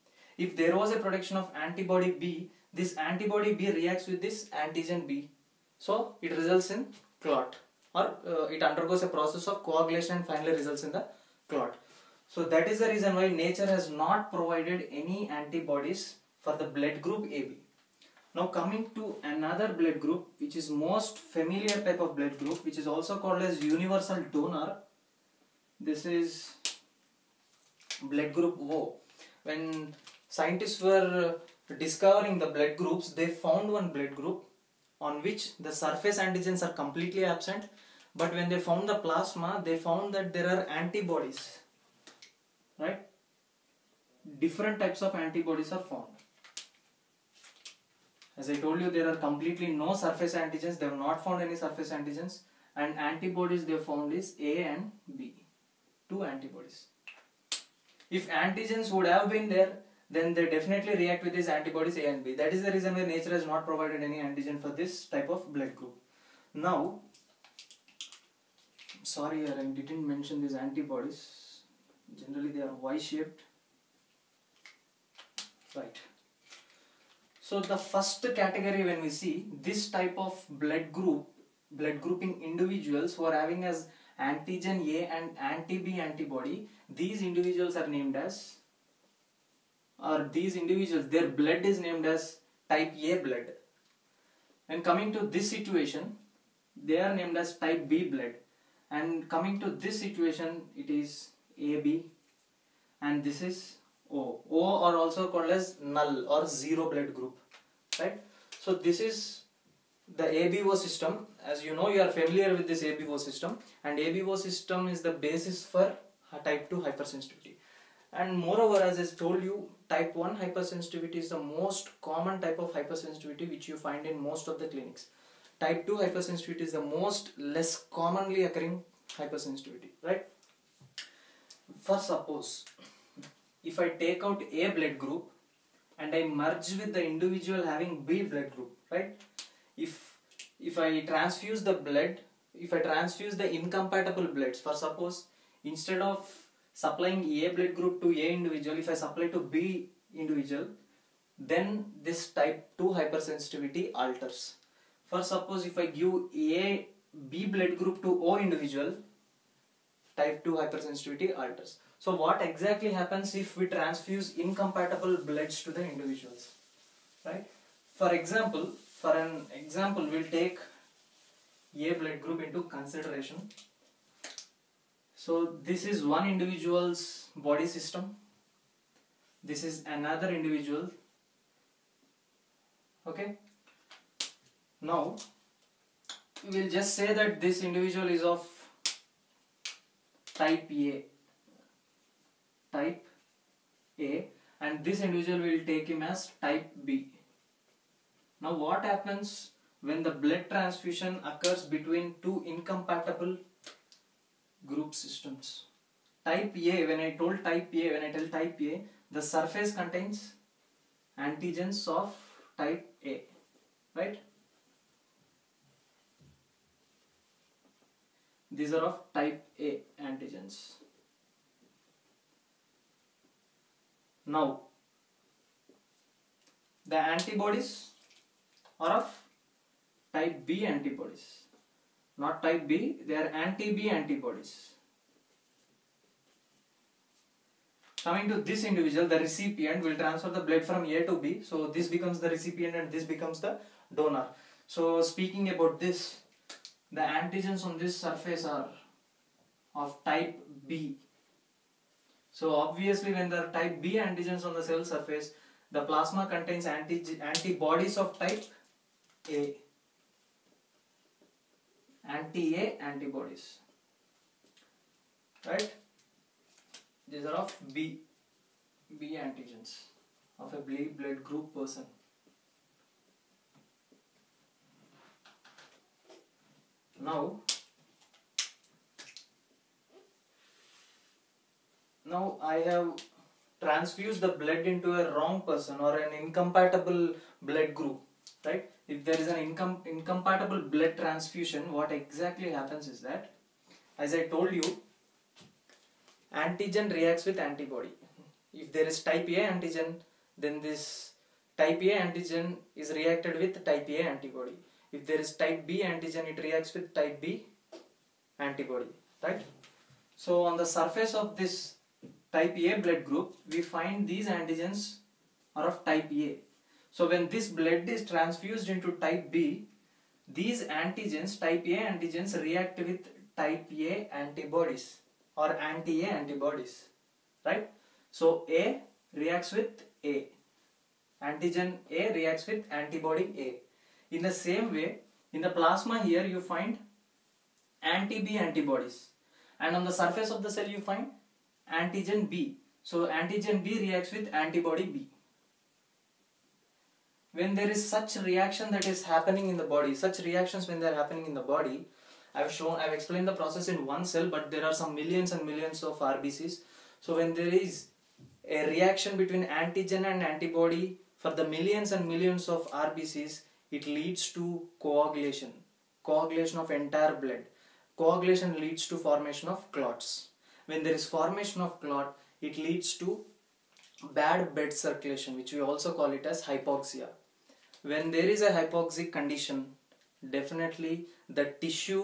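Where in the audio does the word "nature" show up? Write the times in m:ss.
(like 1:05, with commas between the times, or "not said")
0:13, 1:03.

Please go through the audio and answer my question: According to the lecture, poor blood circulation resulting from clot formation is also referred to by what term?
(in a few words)
hypoxia.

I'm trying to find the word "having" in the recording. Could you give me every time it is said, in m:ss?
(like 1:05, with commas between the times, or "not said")
1:23, 2:17.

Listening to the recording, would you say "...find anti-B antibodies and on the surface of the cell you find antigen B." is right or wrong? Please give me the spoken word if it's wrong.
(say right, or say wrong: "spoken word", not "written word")
right.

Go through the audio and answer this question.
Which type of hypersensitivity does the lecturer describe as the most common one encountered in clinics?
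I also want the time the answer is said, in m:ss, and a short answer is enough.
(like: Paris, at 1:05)
type 1, at 1:59.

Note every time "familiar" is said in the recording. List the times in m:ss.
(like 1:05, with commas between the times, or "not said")
0:21, 1:52.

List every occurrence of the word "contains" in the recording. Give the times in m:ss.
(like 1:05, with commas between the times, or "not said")
3:29, 4:16.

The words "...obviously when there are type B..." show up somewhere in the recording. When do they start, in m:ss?
4:12.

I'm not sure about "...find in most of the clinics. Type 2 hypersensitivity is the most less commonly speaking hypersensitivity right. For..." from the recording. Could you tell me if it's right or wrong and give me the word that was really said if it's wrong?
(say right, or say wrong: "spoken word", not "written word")
wrong: "occurring", not "speaking".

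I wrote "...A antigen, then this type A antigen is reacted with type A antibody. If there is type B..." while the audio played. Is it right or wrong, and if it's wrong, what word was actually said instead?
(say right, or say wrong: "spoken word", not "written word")
right.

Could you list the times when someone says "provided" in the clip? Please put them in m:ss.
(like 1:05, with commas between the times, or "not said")
0:14, 1:03.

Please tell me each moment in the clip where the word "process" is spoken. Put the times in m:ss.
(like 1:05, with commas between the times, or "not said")
0:09, 5:53.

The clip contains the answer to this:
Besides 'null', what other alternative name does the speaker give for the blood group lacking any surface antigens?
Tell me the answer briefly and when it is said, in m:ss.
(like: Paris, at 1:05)
zero, at 1:46.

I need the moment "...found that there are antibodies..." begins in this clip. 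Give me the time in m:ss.
0:39.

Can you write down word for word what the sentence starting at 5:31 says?
Antigen A reacts with antibody A.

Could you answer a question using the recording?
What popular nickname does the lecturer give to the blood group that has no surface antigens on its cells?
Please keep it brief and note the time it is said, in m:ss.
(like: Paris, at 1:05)
universal donor, at 0:23.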